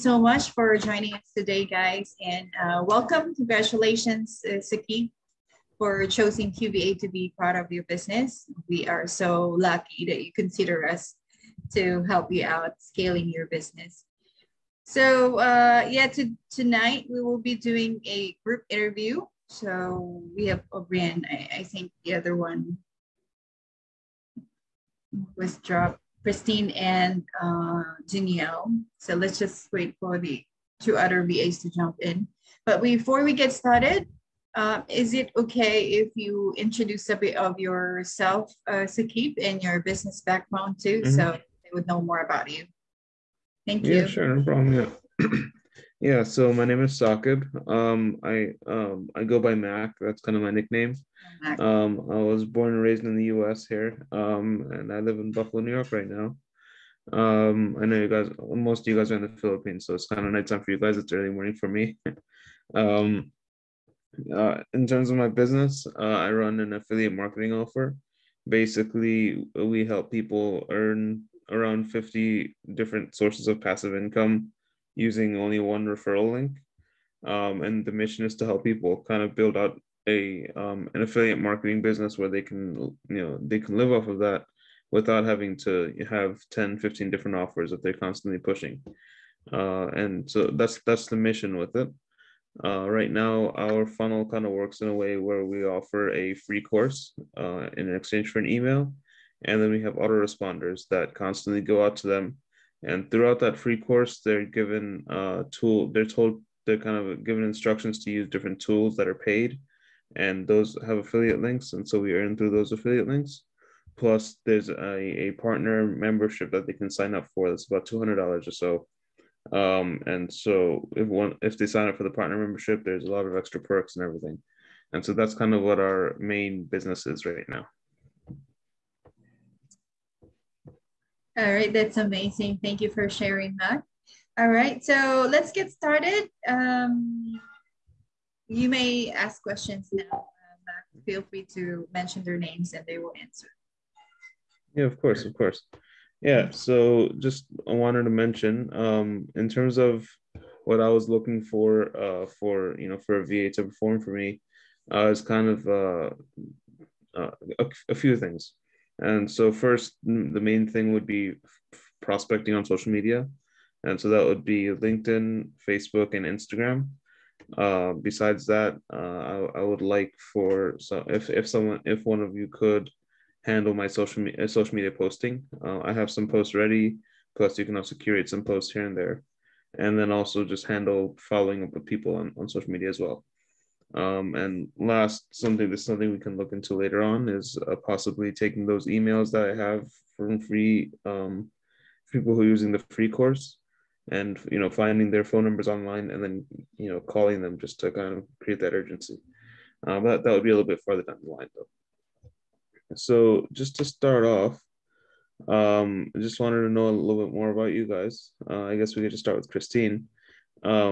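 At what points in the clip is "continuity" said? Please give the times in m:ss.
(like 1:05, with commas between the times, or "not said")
not said.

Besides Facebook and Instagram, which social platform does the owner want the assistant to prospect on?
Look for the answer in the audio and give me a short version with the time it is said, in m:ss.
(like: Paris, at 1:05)
LinkedIn, at 2:44.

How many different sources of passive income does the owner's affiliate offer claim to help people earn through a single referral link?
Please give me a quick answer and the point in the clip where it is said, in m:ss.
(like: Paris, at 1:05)
50, at 1:11.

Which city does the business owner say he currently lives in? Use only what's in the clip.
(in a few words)
Buffalo, New York.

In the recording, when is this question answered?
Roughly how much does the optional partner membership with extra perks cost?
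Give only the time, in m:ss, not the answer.
1:57.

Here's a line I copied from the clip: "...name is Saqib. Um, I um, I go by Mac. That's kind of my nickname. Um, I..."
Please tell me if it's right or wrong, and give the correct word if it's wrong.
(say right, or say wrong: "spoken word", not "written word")
right.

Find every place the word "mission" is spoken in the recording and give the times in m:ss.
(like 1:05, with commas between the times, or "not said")
1:17, 1:31.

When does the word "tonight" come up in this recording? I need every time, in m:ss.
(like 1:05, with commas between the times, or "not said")
0:16.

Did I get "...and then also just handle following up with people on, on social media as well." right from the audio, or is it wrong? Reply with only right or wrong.
right.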